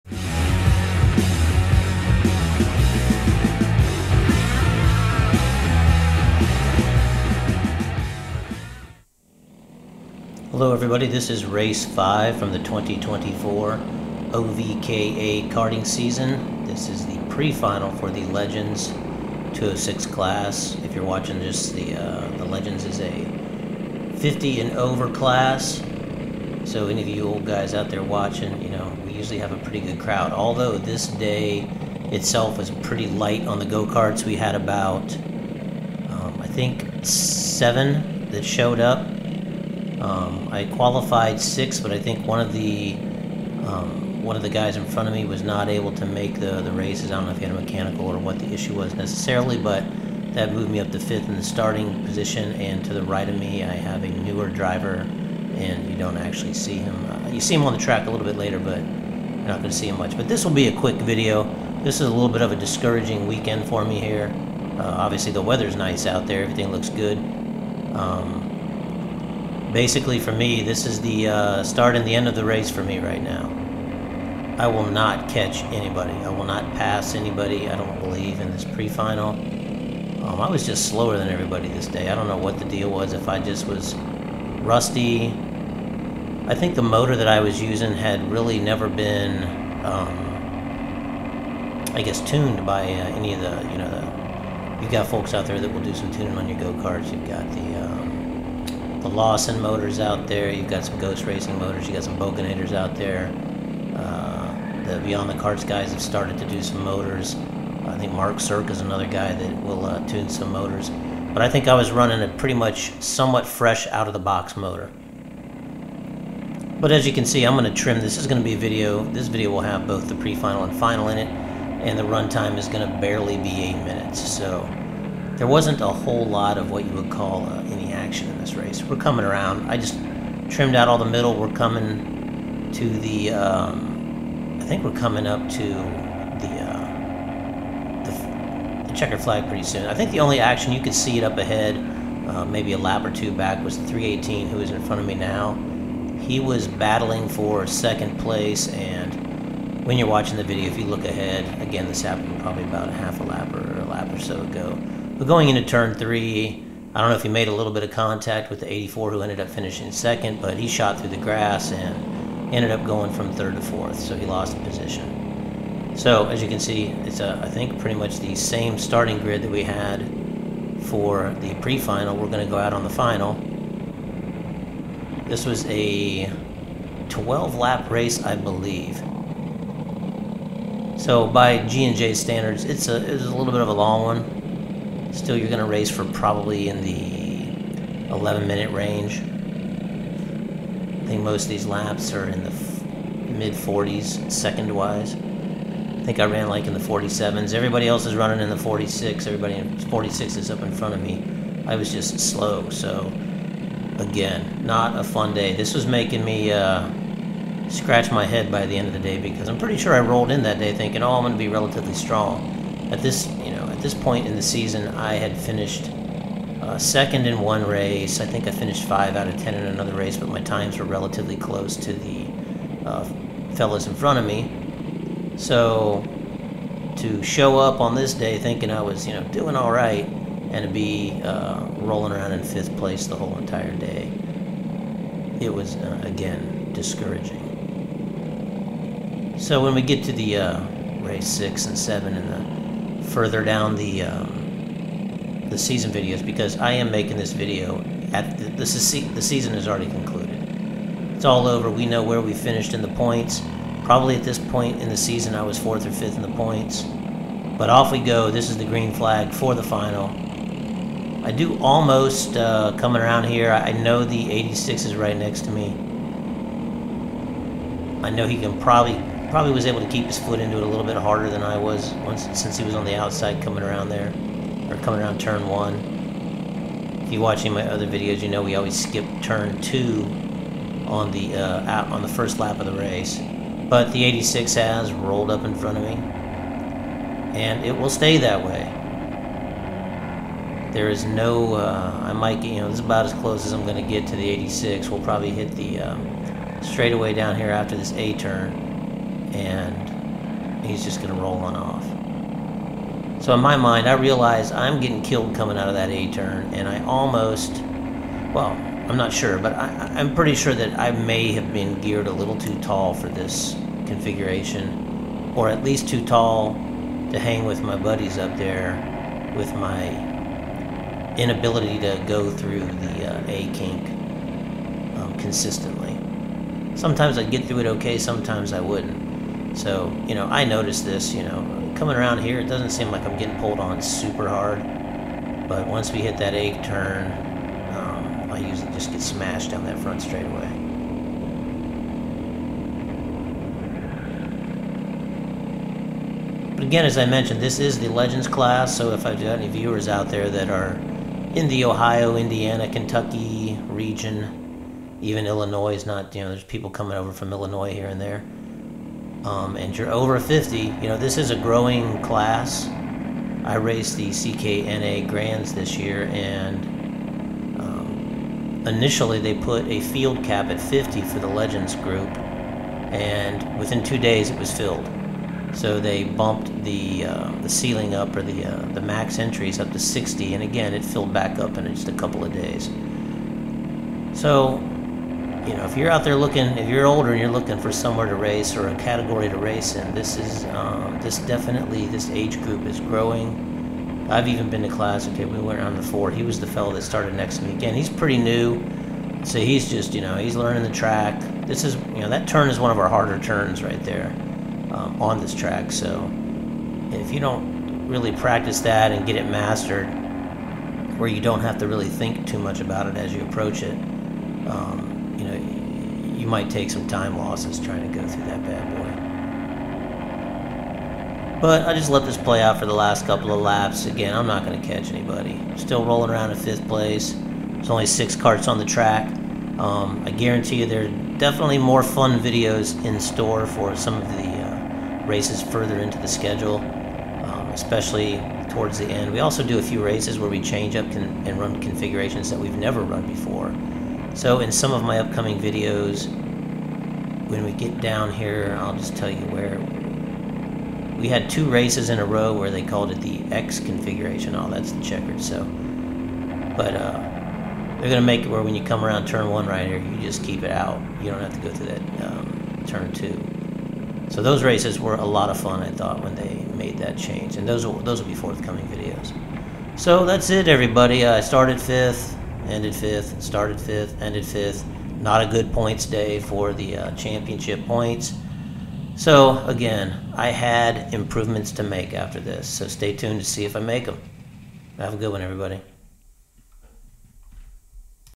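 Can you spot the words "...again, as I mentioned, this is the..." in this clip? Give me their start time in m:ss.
5:46.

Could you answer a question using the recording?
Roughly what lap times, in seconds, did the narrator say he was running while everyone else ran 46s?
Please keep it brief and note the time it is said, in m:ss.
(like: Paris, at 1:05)
47s, at 3:16.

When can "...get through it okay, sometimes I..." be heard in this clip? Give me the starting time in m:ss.
5:27.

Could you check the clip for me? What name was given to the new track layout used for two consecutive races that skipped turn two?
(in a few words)
X configuration.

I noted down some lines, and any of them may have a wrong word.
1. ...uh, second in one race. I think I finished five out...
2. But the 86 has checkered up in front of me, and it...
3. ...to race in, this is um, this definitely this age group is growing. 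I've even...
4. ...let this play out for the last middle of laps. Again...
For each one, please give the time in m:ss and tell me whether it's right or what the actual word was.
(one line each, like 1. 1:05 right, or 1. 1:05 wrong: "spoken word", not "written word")
1. 3:36 right
2. 4:43 wrong: "rolled", not "checkered"
3. 6:29 right
4. 7:01 wrong: "couple", not "middle".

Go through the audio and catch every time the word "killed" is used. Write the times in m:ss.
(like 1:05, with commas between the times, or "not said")
5:05.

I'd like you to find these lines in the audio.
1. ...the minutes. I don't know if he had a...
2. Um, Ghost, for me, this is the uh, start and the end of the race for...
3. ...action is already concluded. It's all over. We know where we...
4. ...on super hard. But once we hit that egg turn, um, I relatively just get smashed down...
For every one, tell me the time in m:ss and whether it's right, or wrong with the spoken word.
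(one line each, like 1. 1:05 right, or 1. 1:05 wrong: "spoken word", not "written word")
1. 0:46 wrong: "races", not "minutes"
2. 1:07 wrong: "Basically", not "Ghost"
3. 4:09 wrong: "season", not "action"
4. 5:33 wrong: "usually", not "relatively".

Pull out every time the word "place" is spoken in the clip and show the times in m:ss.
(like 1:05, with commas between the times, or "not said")
2:28, 3:52, 7:06.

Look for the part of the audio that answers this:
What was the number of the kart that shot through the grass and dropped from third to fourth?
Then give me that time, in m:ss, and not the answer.
2:23.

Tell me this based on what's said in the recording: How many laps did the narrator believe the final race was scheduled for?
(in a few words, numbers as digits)
12.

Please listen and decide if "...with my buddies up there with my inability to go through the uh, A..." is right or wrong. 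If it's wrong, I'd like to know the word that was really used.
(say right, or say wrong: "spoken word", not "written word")
right.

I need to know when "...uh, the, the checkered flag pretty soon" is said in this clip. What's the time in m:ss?
2:16.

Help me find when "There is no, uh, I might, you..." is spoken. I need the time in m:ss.
4:50.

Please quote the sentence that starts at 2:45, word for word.
So as you can see, it's a, I think pretty much the same starting grid that we had for the pre-final.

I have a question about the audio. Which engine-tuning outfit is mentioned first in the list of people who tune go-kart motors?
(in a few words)
Lawson motors.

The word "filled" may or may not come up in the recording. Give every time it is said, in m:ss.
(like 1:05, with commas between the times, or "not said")
6:14, 6:20.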